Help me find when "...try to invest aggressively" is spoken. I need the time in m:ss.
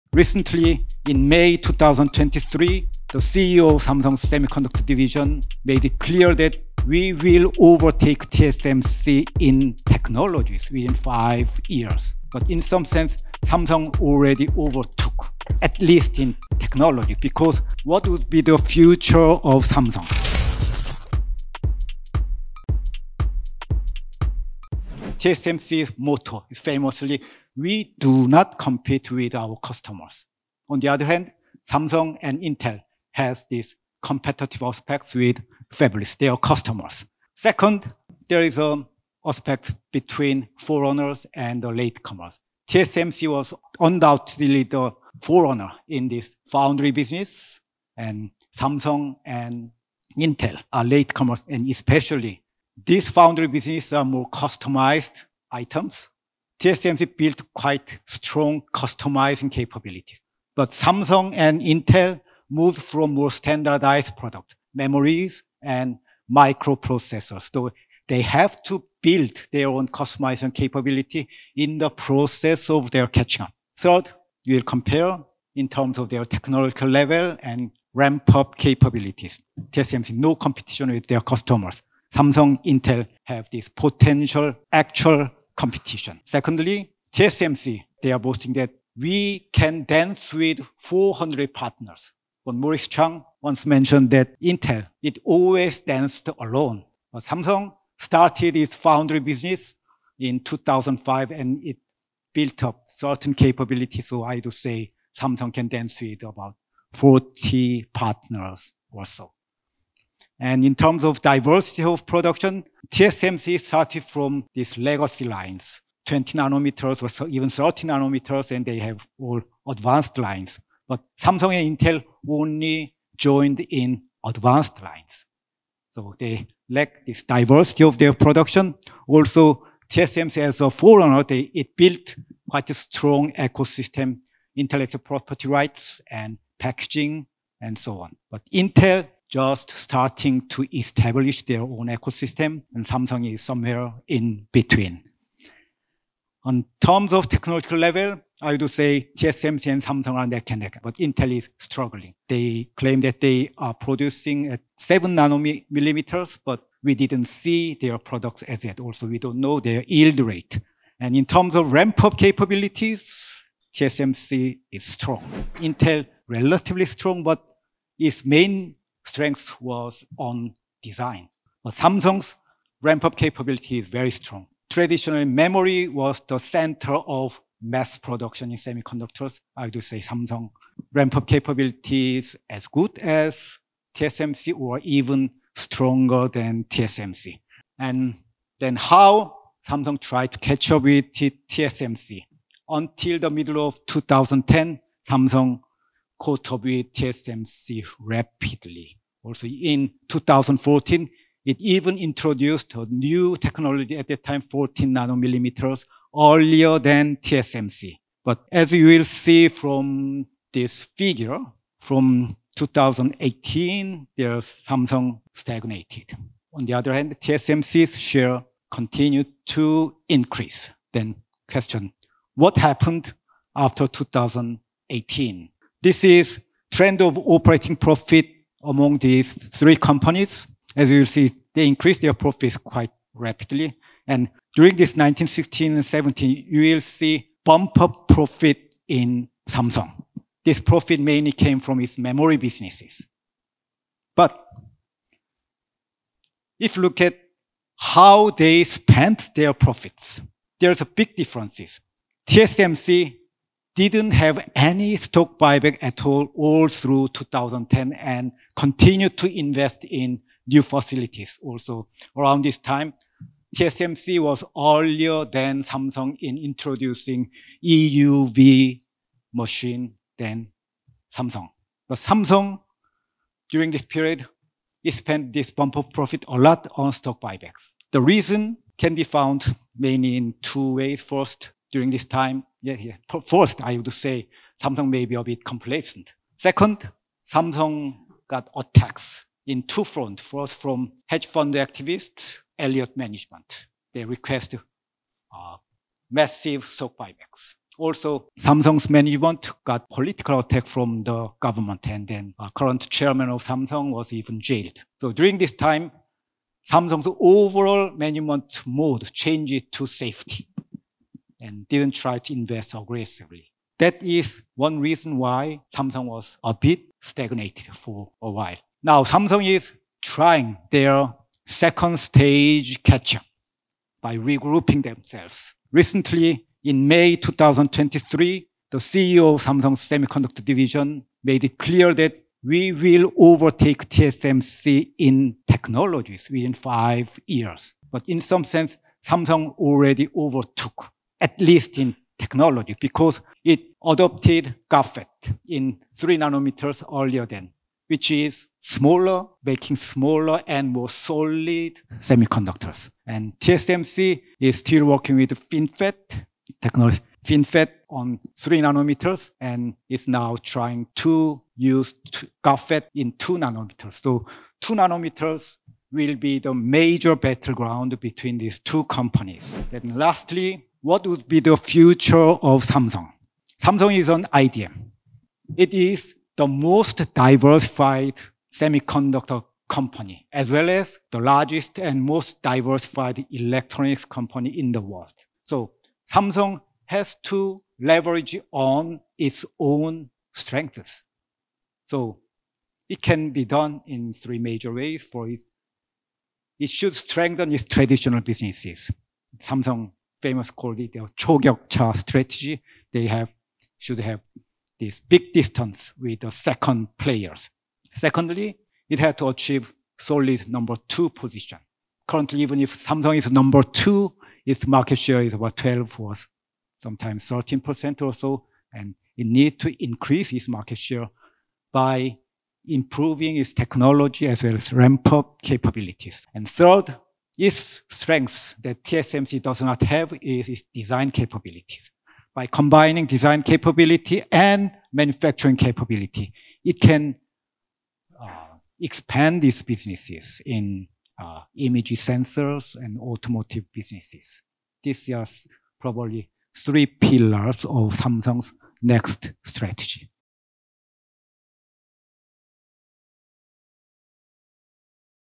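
5:11.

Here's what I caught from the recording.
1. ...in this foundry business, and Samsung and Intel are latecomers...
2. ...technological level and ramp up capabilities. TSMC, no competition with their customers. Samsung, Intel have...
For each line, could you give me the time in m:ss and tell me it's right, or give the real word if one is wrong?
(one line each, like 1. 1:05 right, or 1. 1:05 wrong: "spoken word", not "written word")
1. 0:45 right
2. 1:16 right.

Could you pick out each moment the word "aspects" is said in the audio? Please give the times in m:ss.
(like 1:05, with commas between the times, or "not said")
0:34, 0:39.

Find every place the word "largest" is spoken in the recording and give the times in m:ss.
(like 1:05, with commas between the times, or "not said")
6:21.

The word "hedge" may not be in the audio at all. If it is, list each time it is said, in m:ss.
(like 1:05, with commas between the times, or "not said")
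4:51.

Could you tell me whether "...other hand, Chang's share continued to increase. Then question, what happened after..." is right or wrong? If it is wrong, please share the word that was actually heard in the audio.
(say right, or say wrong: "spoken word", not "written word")
wrong: "TSMC", not "Chang".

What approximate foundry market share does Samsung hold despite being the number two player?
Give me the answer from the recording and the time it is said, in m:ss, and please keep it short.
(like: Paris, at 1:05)
about 12%, at 6:55.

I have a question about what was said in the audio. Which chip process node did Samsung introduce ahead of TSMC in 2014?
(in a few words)
14 nanometers.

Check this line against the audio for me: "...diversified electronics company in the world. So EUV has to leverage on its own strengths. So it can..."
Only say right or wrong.
wrong.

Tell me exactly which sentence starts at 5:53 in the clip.
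And TSMC is still working with FinFET technology, FinFET on three nanometers and is now trying to use GAFET in two nanometers.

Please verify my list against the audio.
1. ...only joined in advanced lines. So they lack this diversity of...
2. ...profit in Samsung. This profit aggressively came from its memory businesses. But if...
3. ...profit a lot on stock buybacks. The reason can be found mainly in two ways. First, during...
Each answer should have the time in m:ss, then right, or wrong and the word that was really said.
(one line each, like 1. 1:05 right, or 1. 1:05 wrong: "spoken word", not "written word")
1. 2:02 right
2. 3:58 wrong: "mainly", not "aggressively"
3. 4:35 right.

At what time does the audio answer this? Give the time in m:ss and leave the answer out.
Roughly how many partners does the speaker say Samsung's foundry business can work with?
1:46.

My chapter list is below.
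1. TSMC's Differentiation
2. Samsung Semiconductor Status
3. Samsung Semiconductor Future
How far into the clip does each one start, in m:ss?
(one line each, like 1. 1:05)
1. 0:25
2. 2:45
3. 6:09.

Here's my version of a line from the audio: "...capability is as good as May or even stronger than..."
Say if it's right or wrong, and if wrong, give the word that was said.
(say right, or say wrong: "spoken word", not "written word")
wrong: "TSMC", not "May".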